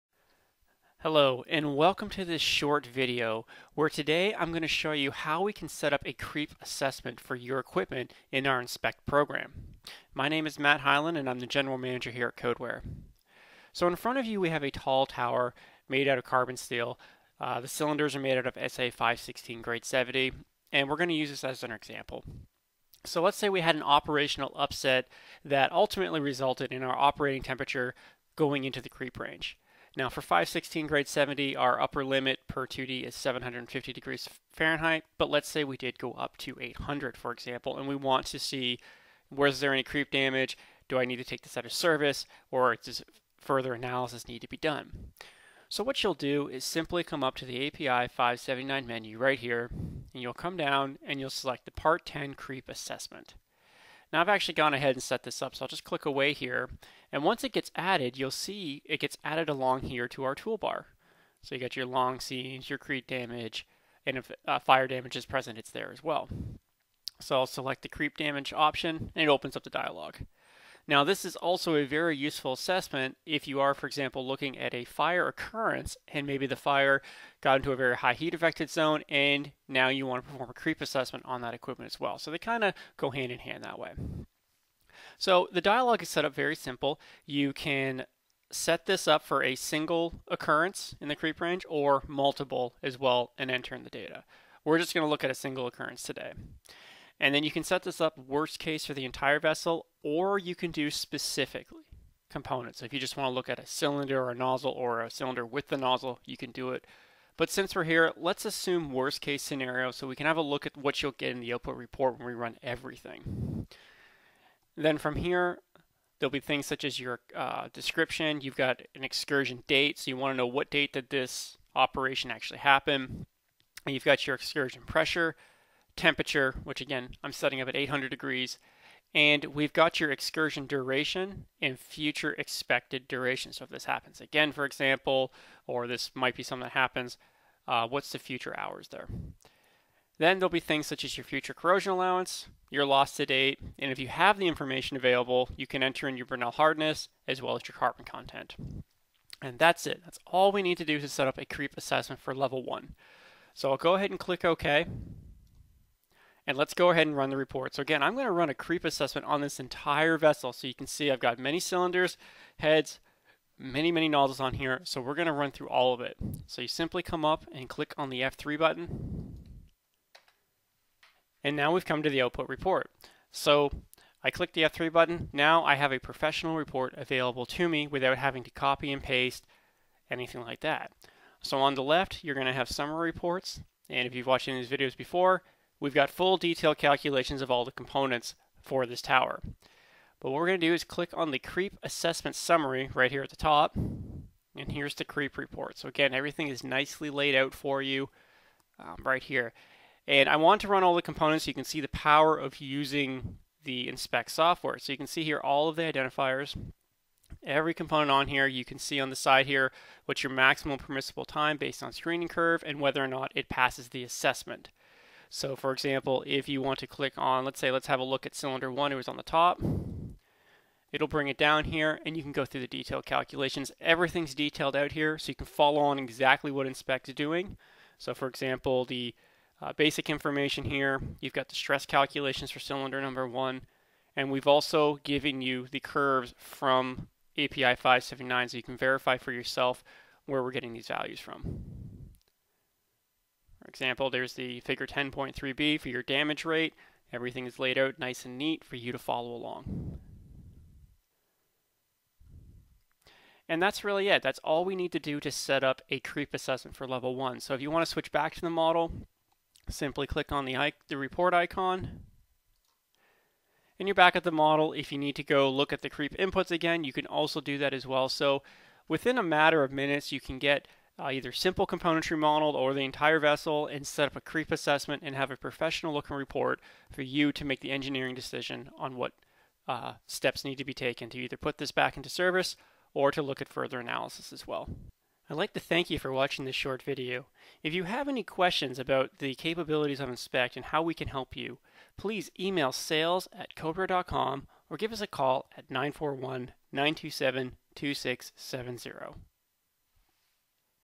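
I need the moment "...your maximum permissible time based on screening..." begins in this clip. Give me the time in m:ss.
3:30.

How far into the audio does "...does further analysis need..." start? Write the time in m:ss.
0:42.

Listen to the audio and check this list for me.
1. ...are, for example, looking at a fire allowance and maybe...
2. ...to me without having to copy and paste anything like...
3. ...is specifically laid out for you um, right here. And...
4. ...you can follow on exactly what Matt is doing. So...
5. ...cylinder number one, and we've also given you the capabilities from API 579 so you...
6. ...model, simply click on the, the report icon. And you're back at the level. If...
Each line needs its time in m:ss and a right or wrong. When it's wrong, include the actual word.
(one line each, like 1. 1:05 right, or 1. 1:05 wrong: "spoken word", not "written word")
1. 1:13 wrong: "occurrence", not "allowance"
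2. 2:57 right
3. 3:16 wrong: "nicely", not "specifically"
4. 3:45 wrong: "Inspect", not "Matt"
5. 3:52 wrong: "curves", not "capabilities"
6. 4:18 wrong: "model", not "level".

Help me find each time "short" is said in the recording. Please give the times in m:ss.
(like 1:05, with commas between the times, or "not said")
0:02, 4:46.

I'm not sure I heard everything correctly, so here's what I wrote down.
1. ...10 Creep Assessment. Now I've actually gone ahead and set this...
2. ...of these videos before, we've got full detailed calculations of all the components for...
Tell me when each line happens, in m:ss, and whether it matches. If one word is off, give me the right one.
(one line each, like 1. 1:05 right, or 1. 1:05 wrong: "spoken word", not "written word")
1. 0:52 right
2. 3:04 right.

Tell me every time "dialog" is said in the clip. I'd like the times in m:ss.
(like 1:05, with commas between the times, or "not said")
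1:09, 1:25.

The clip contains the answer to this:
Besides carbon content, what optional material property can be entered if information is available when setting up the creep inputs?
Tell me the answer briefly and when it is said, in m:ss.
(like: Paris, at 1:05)
Brinell hardness, at 2:26.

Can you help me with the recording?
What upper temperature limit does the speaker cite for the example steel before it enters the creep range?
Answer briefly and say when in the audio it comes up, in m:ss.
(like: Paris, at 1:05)
750 degrees Fahrenheit, at 0:33.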